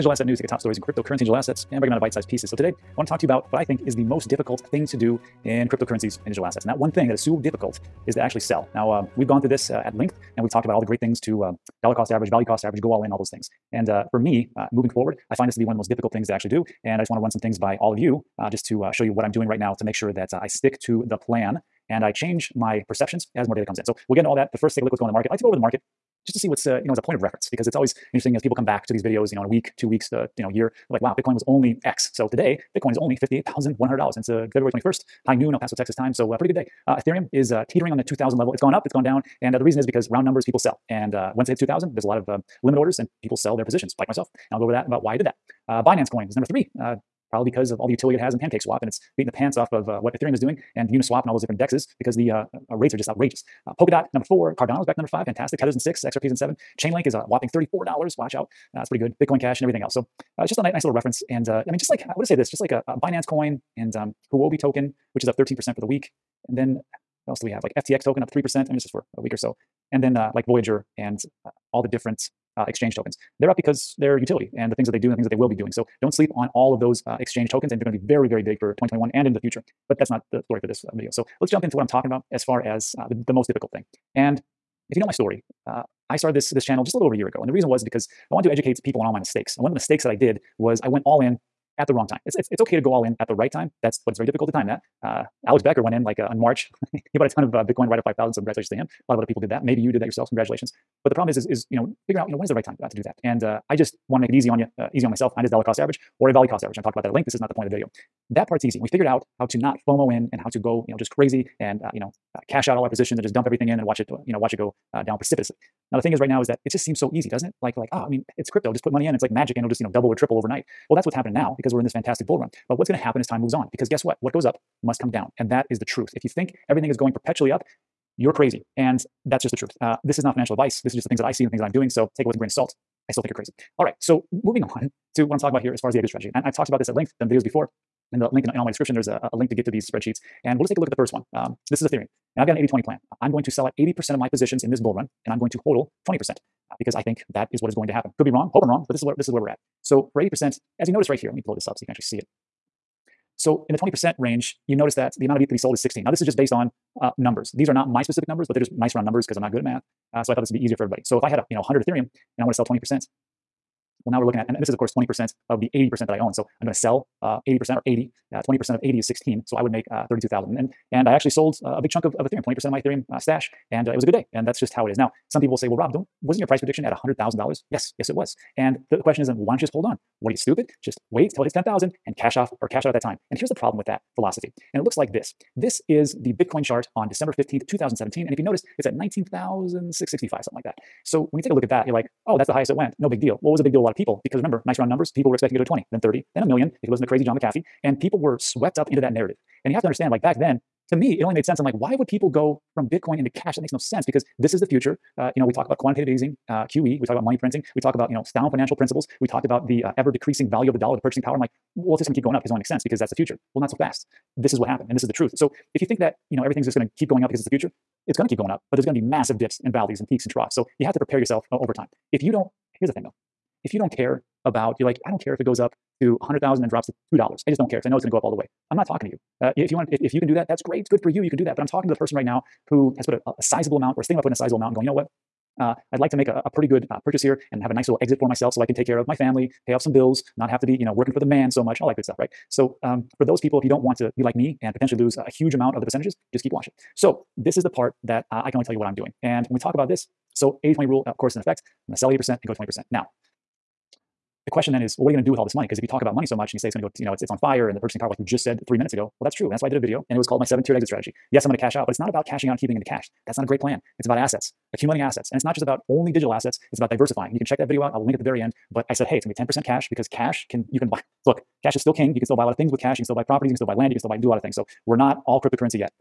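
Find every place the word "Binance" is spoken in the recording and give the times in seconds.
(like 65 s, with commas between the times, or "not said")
45 s, 62 s.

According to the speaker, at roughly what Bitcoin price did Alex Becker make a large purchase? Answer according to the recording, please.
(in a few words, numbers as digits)
5,000.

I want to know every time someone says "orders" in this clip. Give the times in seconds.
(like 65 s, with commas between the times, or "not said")
42 s.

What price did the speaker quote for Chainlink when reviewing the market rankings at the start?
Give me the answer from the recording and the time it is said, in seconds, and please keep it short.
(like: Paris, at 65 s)
$34, at 57 s.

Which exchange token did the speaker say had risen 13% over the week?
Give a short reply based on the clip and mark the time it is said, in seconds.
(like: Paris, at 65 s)
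Huobi token, at 64 s.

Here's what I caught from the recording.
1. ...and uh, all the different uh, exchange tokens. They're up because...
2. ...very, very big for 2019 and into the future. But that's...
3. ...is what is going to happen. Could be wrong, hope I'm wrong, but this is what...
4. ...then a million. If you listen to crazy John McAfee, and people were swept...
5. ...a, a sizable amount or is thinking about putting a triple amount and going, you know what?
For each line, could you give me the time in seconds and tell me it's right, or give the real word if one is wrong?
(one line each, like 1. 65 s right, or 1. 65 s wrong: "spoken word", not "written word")
1. 70 s right
2. 78 s wrong: "2021", not "2019"
3. 147 s right
4. 196 s right
5. 233 s wrong: "sizable", not "triple".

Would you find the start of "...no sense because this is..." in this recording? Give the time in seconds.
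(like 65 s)
203 s.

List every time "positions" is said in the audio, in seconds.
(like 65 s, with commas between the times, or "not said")
43 s, 112 s, 144 s.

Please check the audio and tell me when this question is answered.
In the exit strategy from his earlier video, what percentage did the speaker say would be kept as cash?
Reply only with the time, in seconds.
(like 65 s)
269 s.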